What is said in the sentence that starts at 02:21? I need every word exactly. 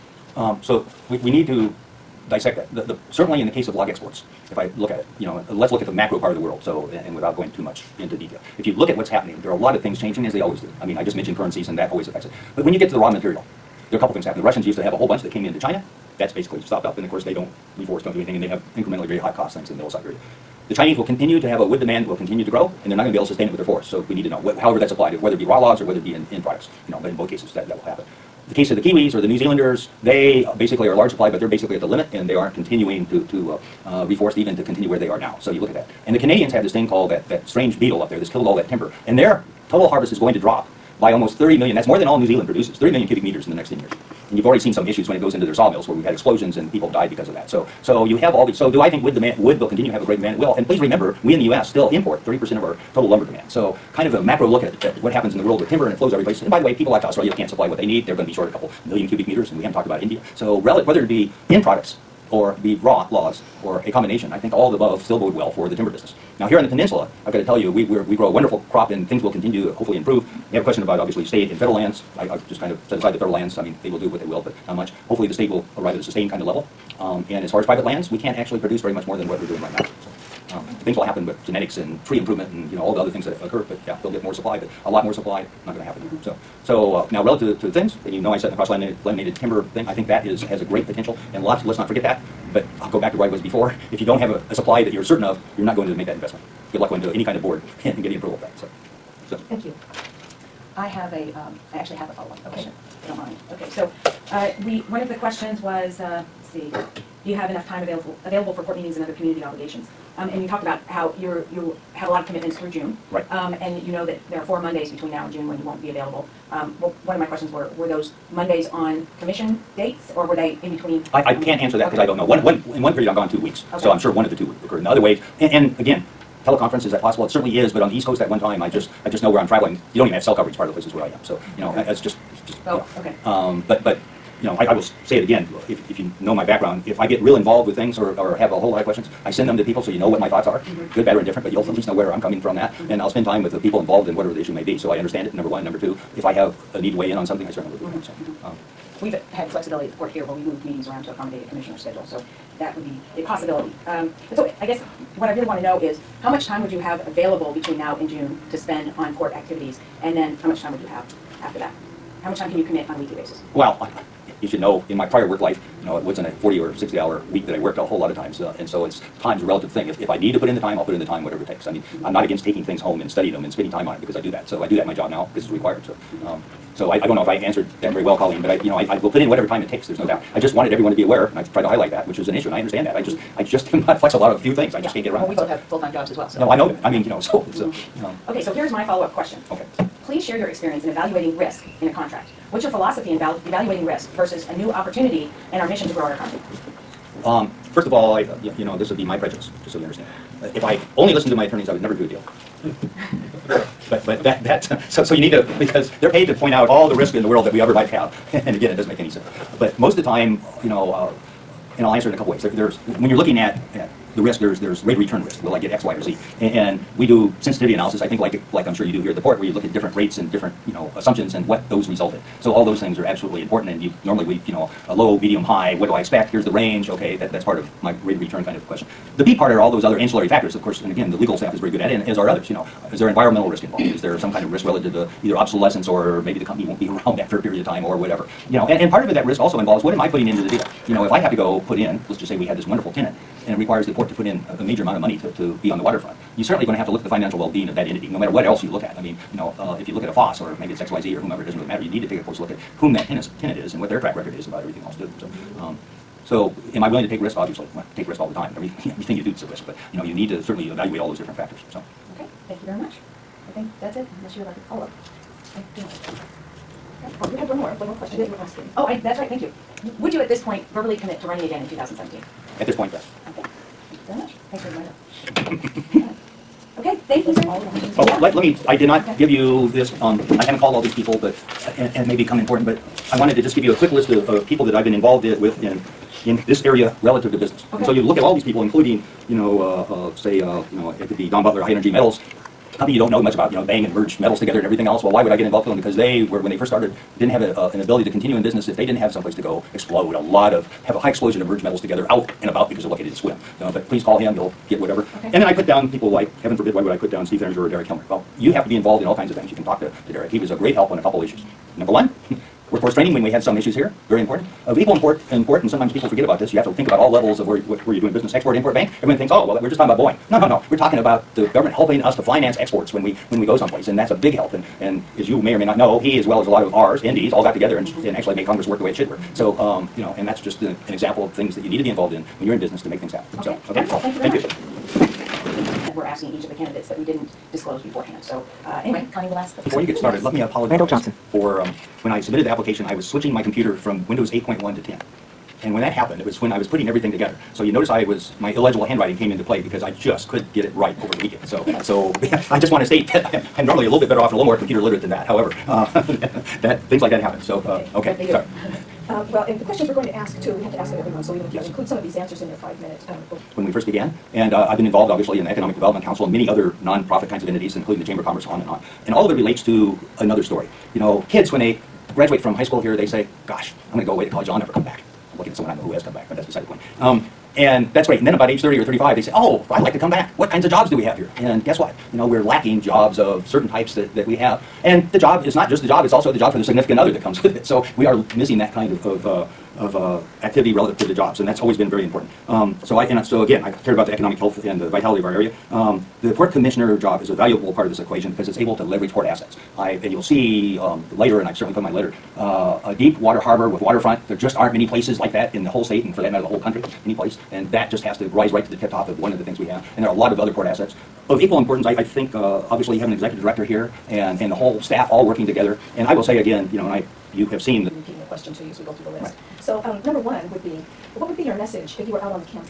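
but you'll at least know where I'm coming from that.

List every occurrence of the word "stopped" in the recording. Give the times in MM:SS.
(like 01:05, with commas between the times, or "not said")
00:16.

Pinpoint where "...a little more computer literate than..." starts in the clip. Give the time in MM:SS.
05:54.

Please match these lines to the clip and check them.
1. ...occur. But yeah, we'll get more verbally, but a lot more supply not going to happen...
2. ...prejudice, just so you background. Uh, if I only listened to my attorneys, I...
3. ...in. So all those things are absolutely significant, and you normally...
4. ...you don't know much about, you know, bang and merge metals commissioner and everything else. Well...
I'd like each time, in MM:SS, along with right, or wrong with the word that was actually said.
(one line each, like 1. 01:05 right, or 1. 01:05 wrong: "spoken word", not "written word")
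1. 01:23 wrong: "supply", not "verbally"
2. 03:19 wrong: "understand", not "background"
3. 03:42 wrong: "important", not "significant"
4. 04:52 wrong: "together", not "commissioner".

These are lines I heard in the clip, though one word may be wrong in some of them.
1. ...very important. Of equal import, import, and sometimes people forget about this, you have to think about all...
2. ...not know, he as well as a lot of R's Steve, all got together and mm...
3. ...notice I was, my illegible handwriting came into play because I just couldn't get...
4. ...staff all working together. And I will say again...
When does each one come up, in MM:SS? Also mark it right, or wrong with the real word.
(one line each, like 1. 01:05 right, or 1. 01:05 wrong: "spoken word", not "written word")
1. 05:14 right
2. 05:25 wrong: "Indies", not "Steve"
3. 05:47 right
4. 06:54 right.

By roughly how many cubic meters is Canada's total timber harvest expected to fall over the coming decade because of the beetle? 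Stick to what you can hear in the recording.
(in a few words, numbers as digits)
30 million.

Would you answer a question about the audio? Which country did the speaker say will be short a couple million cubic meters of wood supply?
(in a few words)
Australia.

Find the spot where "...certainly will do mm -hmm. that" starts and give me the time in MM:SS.
02:27.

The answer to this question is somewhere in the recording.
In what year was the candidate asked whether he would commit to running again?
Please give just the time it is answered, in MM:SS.
04:31.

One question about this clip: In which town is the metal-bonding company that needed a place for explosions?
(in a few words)
Sequim.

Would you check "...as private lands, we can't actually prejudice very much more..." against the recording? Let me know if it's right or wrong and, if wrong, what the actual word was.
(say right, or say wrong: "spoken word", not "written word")
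wrong: "produce", not "prejudice".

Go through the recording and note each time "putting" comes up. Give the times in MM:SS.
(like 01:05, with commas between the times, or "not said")
04:00, 05:46.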